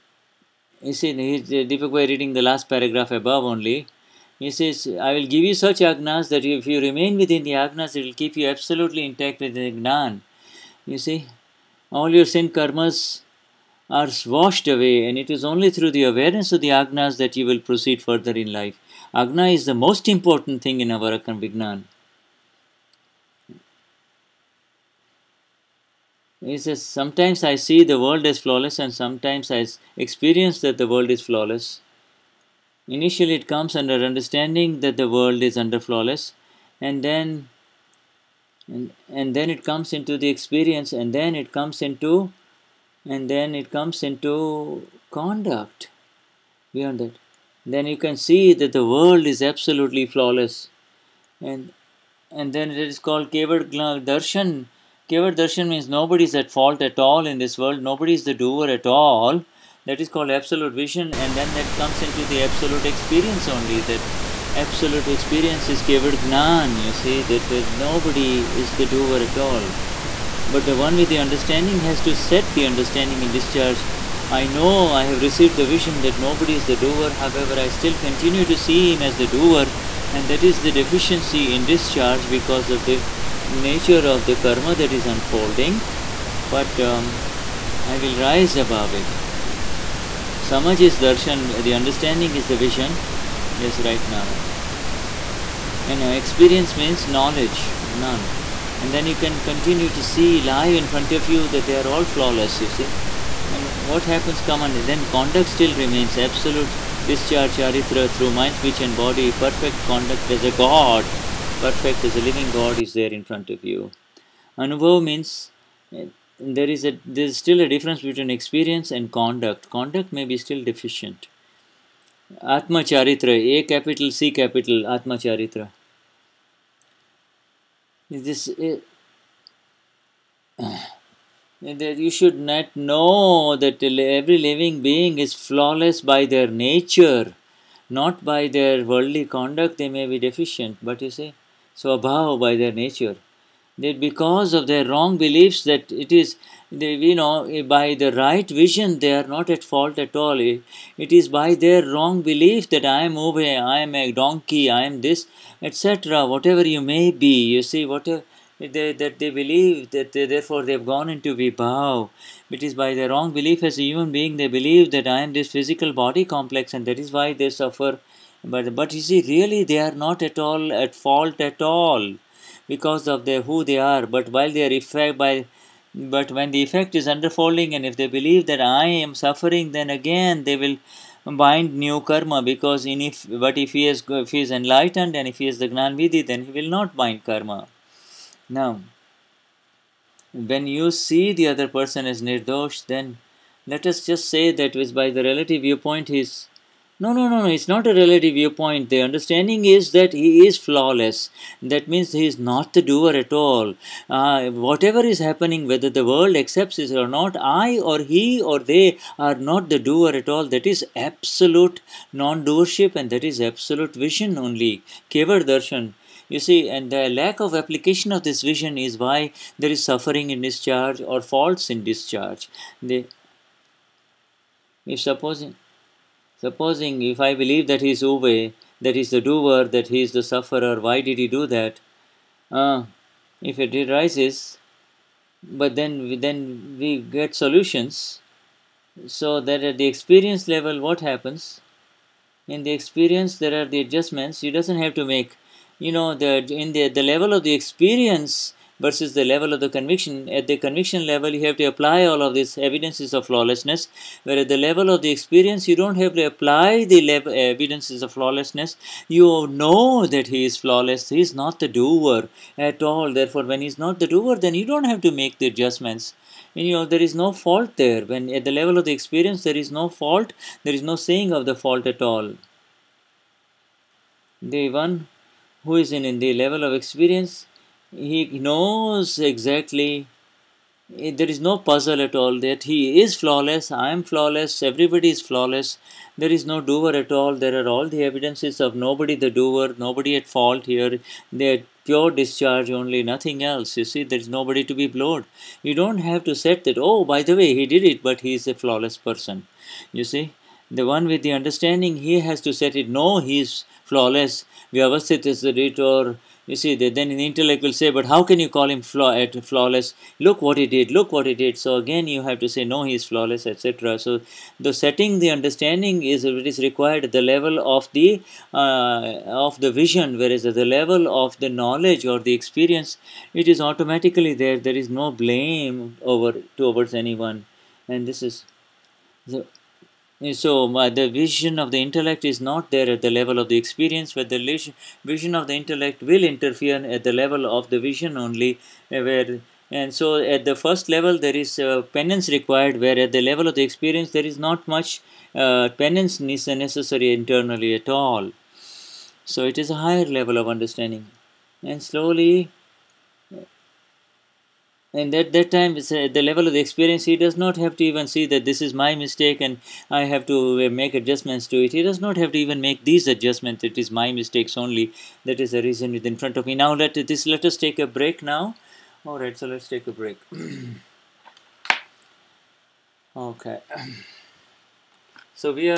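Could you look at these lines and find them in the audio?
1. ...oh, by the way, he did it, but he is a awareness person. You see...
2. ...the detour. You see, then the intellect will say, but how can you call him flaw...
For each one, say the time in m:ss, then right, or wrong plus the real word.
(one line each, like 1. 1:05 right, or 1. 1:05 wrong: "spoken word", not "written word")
1. 4:56 wrong: "flawless", not "awareness"
2. 5:05 right.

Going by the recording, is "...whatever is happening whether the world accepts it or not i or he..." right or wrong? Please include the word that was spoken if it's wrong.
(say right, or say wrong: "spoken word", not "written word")
right.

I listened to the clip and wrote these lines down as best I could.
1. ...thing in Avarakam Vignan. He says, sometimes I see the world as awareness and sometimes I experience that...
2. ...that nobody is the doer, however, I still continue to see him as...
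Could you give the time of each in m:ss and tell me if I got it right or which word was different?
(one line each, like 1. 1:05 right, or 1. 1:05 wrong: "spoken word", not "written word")
1. 0:20 wrong: "flawless", not "awareness"
2. 1:16 right.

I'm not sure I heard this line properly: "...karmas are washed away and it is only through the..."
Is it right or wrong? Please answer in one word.
right.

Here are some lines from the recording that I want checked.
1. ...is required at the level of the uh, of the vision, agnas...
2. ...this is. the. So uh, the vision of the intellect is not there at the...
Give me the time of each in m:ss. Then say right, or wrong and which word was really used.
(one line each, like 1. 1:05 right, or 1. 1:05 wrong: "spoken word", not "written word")
1. 5:16 wrong: "whereas", not "agnas"
2. 5:28 right.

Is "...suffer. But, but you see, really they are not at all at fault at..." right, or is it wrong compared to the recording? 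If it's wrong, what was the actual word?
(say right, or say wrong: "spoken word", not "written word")
right.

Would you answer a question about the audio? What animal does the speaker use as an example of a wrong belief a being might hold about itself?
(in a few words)
A donkey.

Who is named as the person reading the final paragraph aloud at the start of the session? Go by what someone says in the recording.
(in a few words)
Deepak Bhai.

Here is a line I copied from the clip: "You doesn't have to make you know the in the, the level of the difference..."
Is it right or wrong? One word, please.
wrong.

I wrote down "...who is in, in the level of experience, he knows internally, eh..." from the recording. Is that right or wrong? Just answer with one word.
wrong.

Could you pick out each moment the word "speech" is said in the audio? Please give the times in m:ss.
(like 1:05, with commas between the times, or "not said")
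1:48.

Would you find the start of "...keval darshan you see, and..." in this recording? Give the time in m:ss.
3:35.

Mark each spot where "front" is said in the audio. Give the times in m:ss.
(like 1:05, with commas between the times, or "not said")
1:40, 1:53, 6:06.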